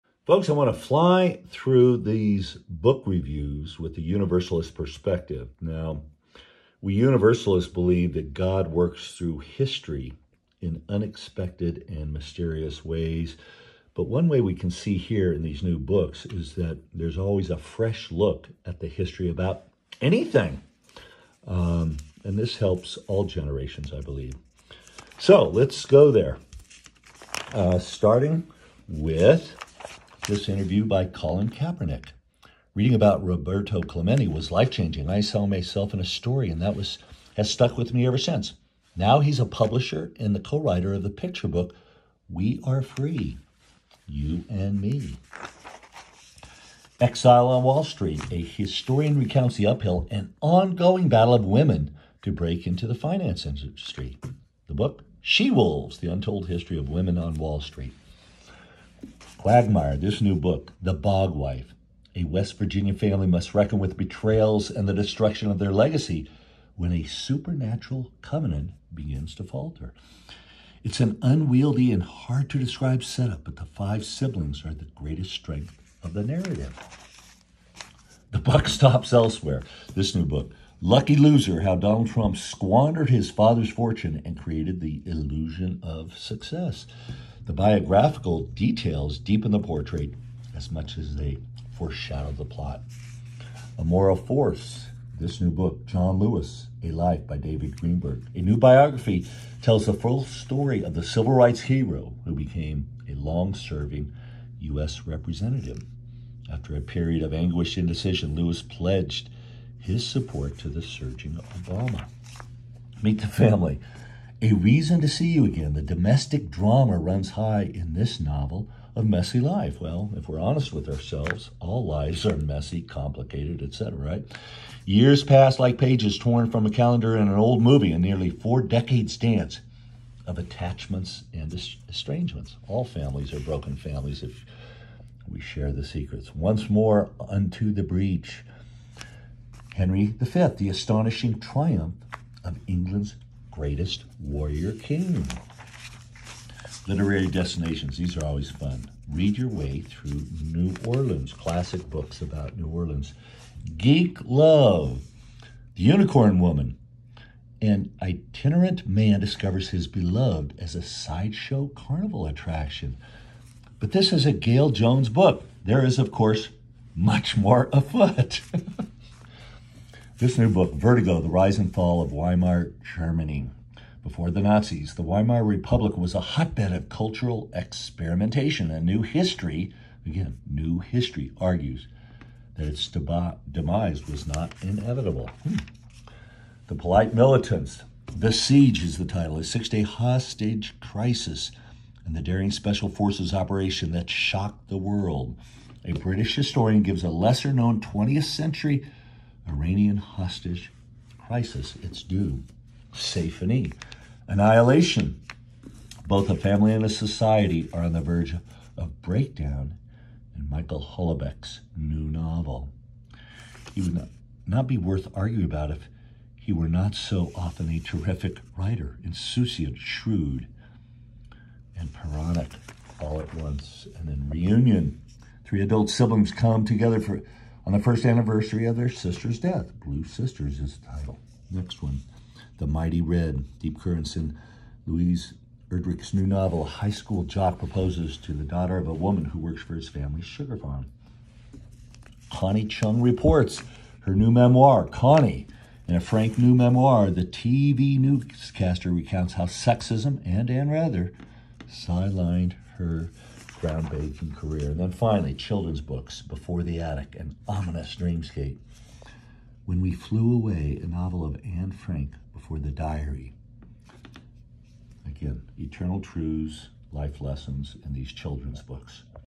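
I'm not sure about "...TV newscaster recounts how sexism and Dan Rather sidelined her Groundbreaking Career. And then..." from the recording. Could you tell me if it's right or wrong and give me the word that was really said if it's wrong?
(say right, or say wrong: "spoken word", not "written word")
right.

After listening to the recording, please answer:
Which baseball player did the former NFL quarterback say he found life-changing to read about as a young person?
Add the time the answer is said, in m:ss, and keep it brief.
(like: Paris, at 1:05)
Roberto Clemente, at 0:33.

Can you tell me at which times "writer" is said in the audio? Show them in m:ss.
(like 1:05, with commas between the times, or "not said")
0:40, 3:38.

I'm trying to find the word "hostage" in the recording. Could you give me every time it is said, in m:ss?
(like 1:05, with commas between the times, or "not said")
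3:09, 3:19.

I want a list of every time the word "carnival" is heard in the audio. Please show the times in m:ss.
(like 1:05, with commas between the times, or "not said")
2:41.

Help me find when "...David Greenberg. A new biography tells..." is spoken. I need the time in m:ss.
1:37.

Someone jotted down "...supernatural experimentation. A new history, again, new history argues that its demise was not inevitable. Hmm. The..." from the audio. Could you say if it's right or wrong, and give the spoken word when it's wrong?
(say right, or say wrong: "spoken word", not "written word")
wrong: "cultural", not "supernatural".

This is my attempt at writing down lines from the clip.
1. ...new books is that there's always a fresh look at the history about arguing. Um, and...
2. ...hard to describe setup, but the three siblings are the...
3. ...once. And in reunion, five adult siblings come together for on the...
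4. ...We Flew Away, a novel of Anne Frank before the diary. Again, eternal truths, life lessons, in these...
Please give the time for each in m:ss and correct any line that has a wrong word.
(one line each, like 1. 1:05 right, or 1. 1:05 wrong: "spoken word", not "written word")
1. 0:15 wrong: "anything", not "arguing"
2. 1:12 wrong: "five", not "three"
3. 3:43 wrong: "three", not "five"
4. 4:19 right.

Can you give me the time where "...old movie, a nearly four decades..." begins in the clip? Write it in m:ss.
2:07.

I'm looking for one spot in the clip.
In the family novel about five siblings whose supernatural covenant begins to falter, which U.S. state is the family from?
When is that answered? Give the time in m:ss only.
1:02.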